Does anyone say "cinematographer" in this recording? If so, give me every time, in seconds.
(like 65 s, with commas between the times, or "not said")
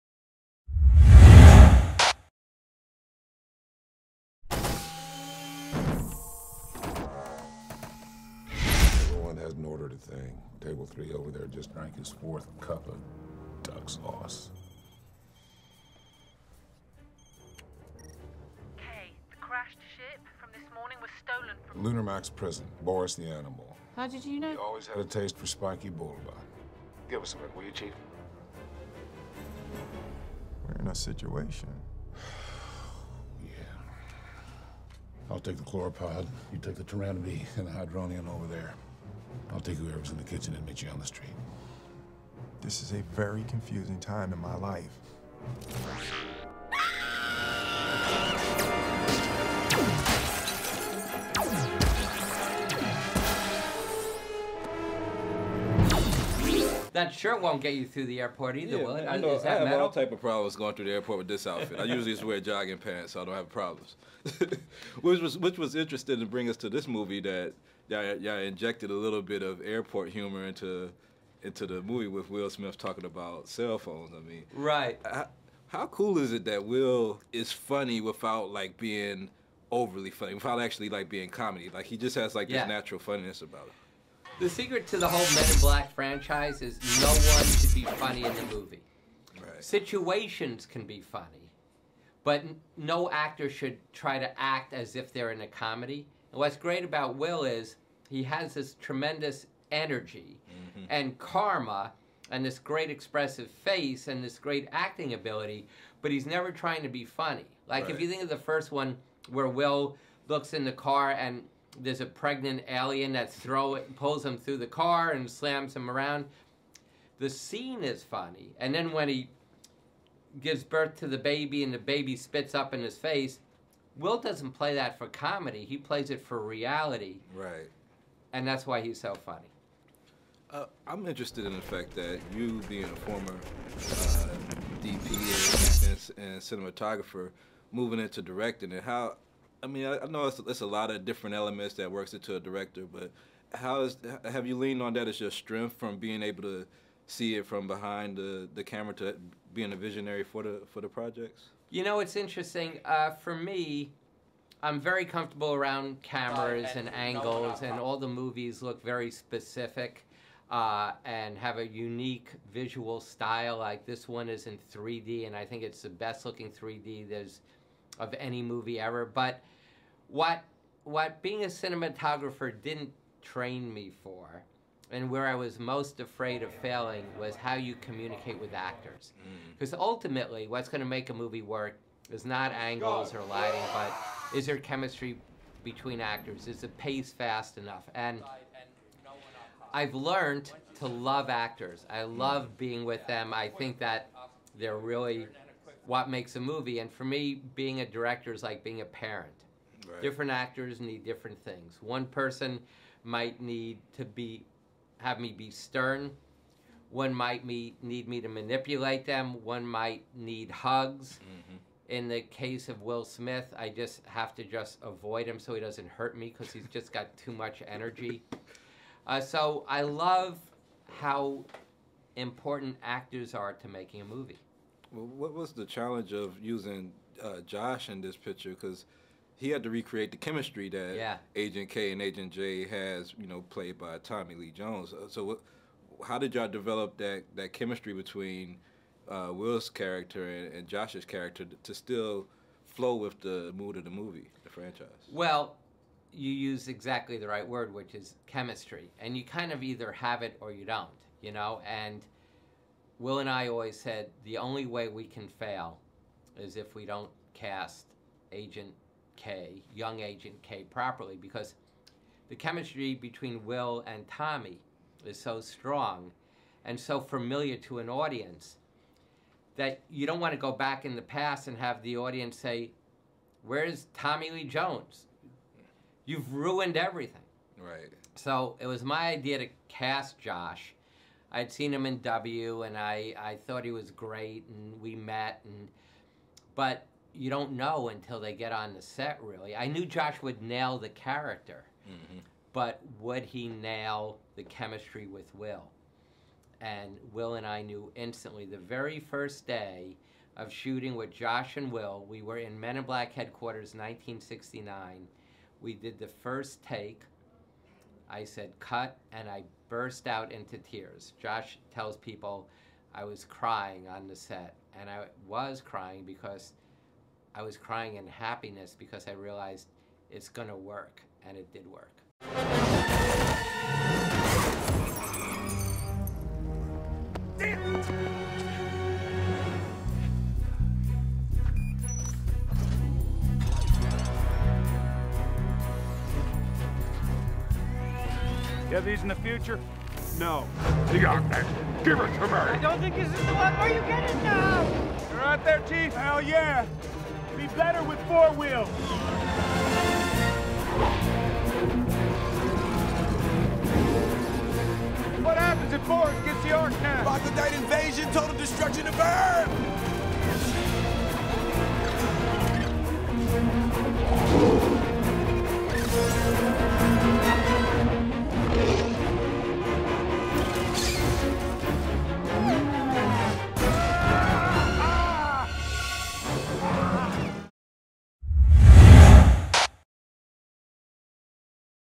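136 s, 171 s.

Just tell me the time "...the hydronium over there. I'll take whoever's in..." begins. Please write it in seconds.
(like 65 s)
37 s.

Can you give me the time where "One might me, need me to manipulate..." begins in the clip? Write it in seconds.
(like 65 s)
206 s.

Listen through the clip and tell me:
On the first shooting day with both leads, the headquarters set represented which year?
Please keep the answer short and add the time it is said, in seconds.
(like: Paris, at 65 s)
1969, at 303 s.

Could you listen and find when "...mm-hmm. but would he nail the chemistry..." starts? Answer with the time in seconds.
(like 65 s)
291 s.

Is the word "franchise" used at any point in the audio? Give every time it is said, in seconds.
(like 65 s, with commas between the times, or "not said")
85 s, 244 s.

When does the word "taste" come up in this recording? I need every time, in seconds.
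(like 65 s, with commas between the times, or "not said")
25 s.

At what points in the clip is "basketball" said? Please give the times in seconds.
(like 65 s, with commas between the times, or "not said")
not said.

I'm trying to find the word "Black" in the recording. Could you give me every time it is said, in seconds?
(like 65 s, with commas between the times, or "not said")
85 s, 302 s.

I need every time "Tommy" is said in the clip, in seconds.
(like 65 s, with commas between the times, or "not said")
233 s, 264 s, 273 s.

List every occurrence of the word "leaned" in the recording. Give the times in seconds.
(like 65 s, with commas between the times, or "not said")
144 s.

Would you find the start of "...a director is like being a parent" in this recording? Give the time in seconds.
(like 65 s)
197 s.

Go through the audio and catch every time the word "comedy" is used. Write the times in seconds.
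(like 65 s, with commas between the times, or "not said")
81 s, 95 s, 125 s.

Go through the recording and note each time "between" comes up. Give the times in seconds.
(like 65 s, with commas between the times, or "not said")
185 s, 237 s, 262 s.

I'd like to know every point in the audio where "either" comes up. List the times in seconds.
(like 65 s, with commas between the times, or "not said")
58 s, 249 s.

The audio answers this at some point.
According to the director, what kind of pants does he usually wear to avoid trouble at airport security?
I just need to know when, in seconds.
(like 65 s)
62 s.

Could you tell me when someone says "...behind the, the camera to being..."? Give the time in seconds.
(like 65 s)
147 s.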